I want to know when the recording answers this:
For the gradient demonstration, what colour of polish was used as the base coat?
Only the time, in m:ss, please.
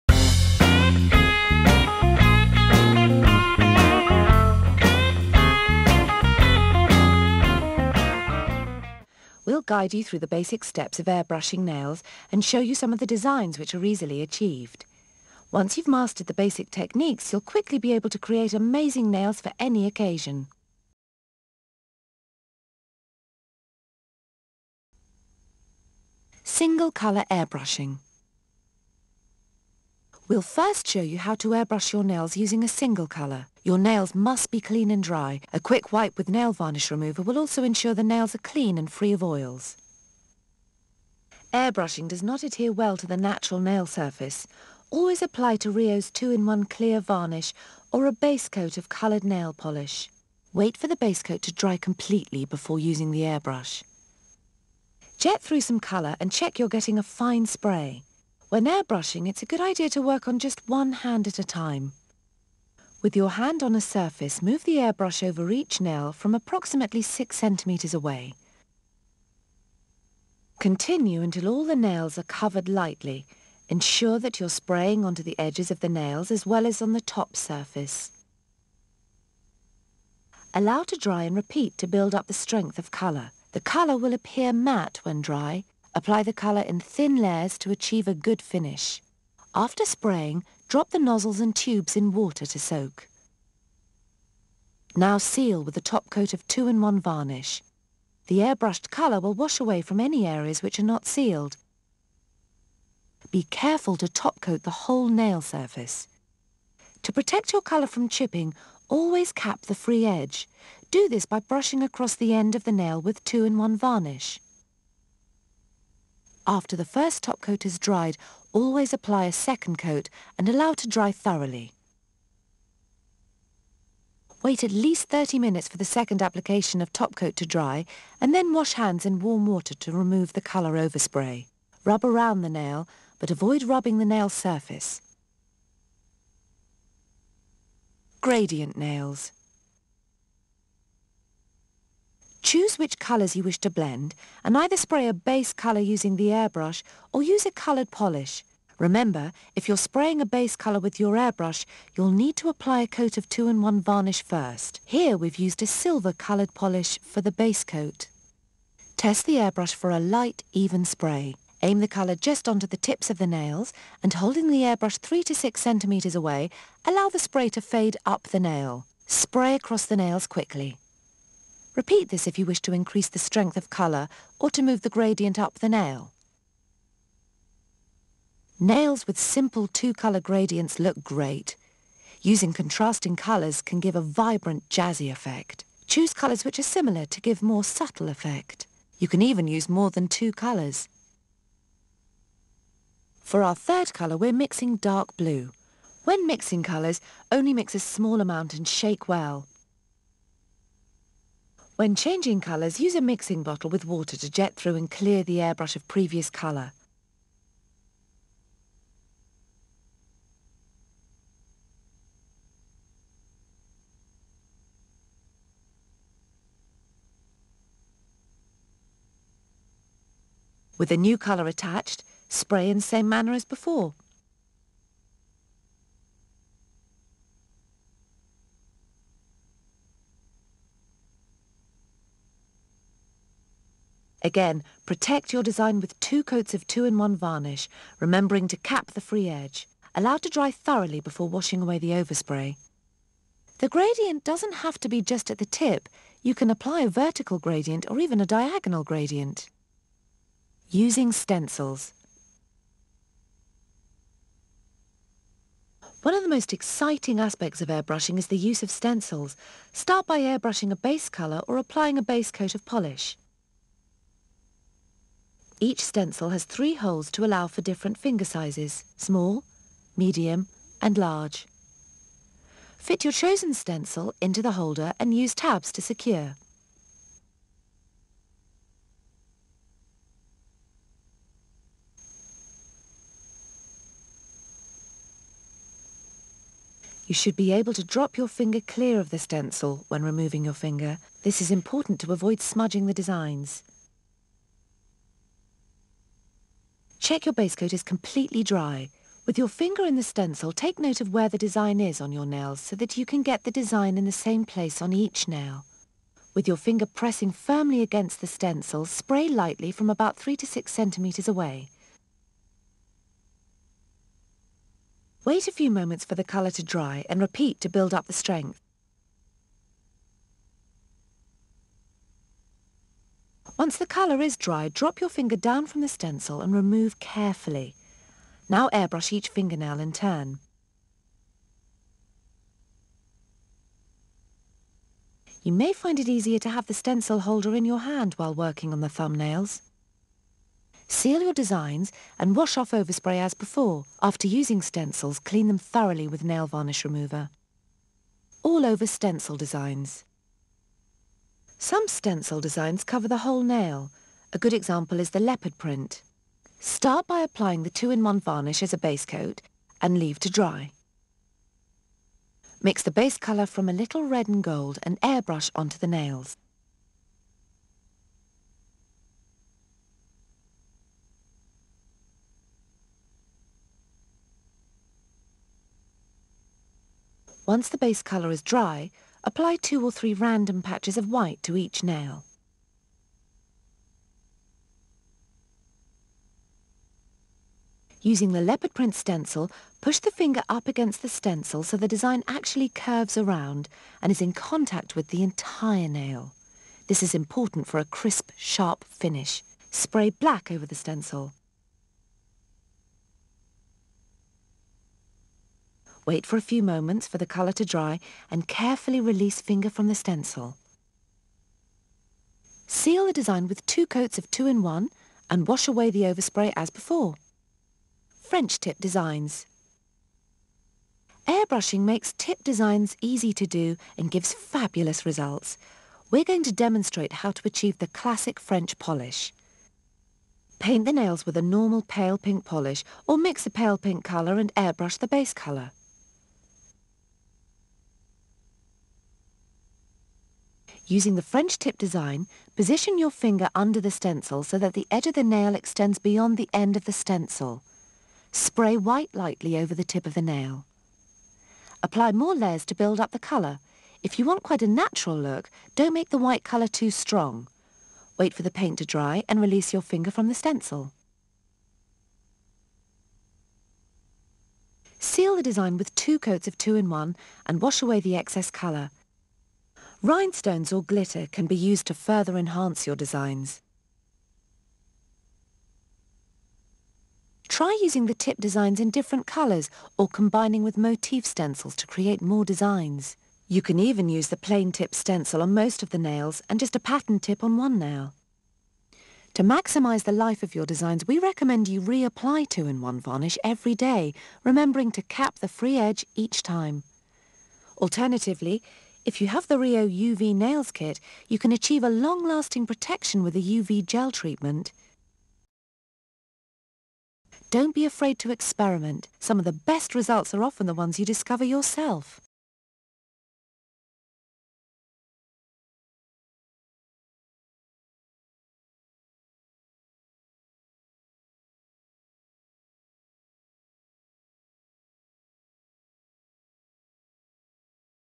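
2:35.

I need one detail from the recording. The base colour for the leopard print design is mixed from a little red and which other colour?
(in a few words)
Gold.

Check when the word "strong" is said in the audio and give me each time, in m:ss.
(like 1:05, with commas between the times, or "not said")
7:36.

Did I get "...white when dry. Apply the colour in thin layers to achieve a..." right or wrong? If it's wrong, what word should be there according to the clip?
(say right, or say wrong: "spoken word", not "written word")
wrong: "matte", not "white".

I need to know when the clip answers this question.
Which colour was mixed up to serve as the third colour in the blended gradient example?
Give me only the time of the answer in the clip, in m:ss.
3:14.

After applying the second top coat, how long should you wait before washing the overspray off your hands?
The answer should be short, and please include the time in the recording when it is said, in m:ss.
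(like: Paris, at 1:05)
30 minutes, at 2:05.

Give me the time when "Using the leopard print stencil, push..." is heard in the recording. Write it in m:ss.
6:28.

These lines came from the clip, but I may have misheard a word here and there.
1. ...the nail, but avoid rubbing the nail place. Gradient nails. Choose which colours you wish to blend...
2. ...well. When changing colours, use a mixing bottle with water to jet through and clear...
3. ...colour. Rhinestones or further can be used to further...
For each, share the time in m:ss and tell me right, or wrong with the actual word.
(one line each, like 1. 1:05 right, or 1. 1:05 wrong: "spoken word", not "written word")
1. 2:12 wrong: "surface", not "place"
2. 3:19 right
3. 7:48 wrong: "glitter", not "further".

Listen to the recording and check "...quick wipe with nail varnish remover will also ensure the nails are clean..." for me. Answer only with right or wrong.
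right.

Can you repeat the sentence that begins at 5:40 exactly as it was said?
Seal your designs and wash off overspray as before.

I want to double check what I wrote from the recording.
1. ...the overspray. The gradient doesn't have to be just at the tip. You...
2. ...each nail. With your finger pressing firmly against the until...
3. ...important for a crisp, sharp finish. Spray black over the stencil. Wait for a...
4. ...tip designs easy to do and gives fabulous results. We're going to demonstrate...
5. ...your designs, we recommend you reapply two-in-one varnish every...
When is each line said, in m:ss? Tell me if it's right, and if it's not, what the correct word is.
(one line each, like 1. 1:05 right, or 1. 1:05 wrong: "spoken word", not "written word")
1. 4:01 right
2. 5:04 wrong: "stencil", not "until"
3. 6:37 right
4. 7:02 right
5. 8:10 right.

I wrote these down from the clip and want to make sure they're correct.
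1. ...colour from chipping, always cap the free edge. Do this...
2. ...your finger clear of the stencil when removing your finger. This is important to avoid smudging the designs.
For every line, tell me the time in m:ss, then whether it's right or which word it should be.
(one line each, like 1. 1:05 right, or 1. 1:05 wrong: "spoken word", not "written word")
1. 1:47 right
2. 4:48 right.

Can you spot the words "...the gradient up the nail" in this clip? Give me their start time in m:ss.
2:54.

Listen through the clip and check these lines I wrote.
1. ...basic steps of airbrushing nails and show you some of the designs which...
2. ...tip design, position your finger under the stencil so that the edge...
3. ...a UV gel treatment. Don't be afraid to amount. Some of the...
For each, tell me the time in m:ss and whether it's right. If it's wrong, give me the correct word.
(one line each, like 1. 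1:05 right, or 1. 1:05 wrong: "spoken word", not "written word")
1. 0:10 right
2. 7:21 right
3. 8:23 wrong: "experiment", not "amount".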